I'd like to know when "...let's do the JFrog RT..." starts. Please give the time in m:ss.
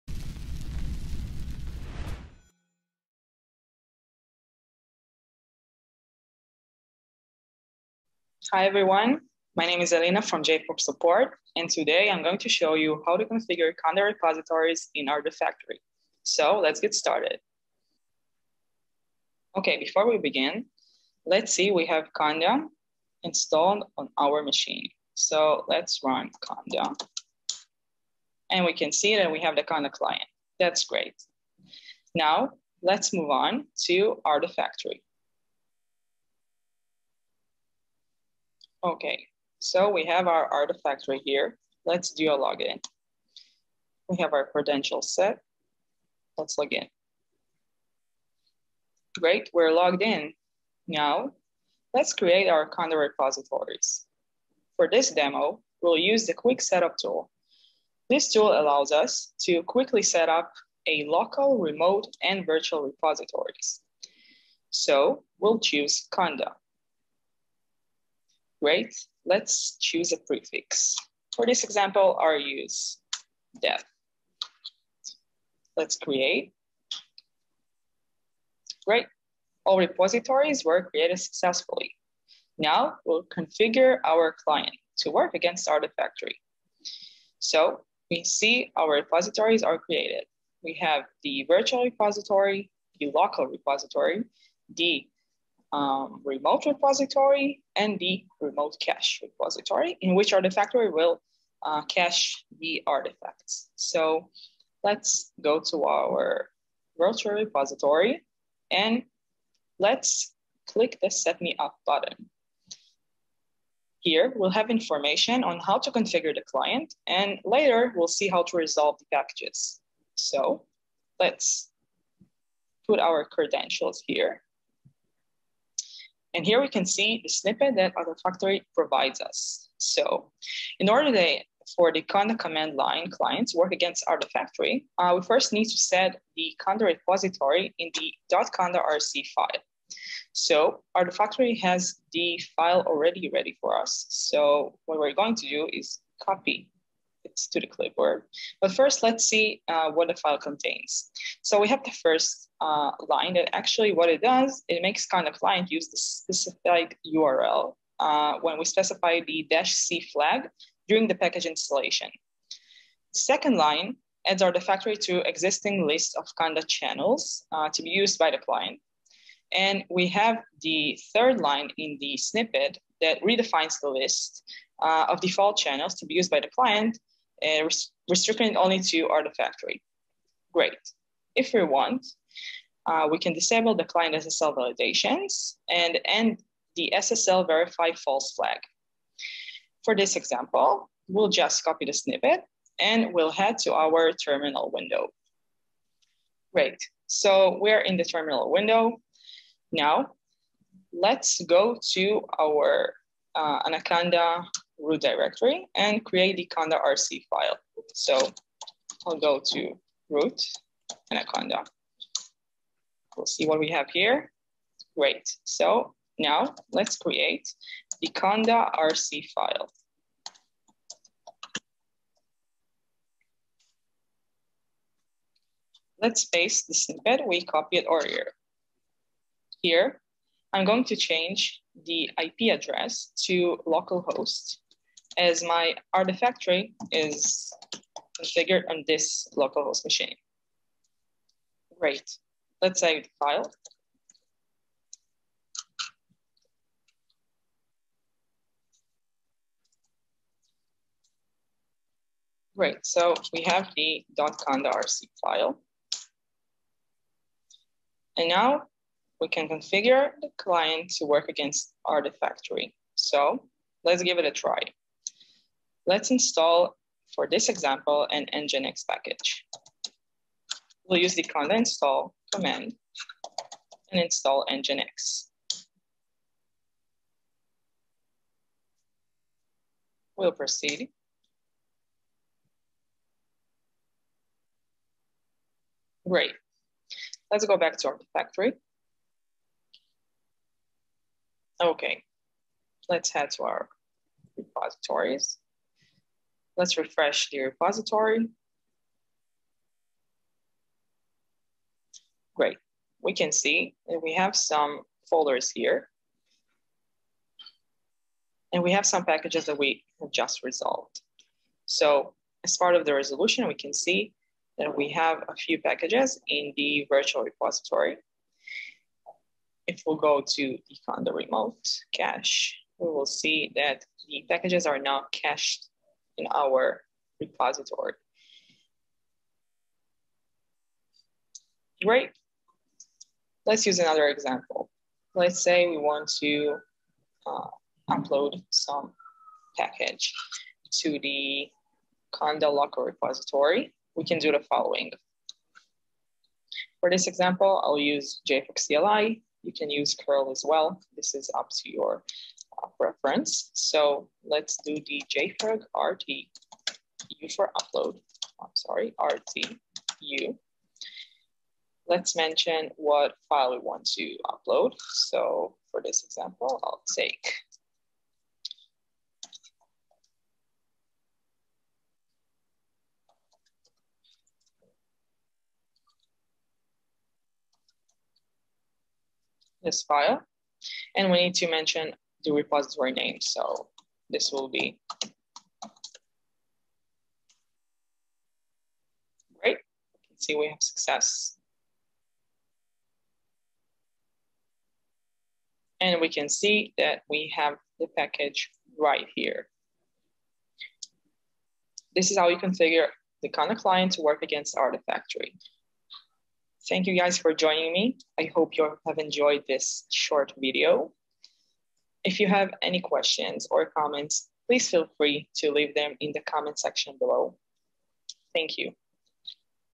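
5:54.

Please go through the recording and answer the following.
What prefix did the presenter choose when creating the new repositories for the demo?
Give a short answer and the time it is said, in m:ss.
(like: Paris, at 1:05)
death, at 1:13.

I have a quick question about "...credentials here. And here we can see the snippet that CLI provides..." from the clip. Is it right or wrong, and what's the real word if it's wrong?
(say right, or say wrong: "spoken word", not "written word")
wrong: "Artifactory", not "CLI".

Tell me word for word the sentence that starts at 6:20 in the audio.
And we need to mention the repository name.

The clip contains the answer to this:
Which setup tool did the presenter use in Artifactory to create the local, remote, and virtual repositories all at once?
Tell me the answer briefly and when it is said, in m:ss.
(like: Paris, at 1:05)
quick setup tool, at 0:56.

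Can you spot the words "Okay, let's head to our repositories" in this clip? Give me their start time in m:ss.
4:51.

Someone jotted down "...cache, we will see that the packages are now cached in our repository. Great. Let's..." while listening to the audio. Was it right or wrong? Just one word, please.
right.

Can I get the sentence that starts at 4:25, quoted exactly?
Let's install, for this example, an Nginx package.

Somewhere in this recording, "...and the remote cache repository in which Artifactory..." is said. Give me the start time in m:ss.
1:37.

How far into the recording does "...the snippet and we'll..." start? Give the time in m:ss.
3:11.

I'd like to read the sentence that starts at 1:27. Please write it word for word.
So we see our repositories are created.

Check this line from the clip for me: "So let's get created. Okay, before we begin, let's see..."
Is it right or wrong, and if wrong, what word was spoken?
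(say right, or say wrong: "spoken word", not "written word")
wrong: "started", not "created".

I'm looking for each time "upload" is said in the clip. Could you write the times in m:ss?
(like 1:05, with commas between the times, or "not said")
5:37, 5:57, 6:04.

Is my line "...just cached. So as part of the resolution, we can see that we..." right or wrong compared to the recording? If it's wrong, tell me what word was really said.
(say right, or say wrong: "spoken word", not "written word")
wrong: "resolved", not "cached".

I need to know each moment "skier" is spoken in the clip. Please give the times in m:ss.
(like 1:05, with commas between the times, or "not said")
not said.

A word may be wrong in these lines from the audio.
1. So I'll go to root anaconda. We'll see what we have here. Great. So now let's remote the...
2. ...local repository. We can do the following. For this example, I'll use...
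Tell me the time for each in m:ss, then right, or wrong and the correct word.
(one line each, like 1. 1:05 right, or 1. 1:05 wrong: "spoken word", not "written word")
1. 3:27 wrong: "create", not "remote"
2. 5:42 right.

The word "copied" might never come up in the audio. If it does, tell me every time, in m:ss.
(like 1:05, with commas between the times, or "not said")
3:47.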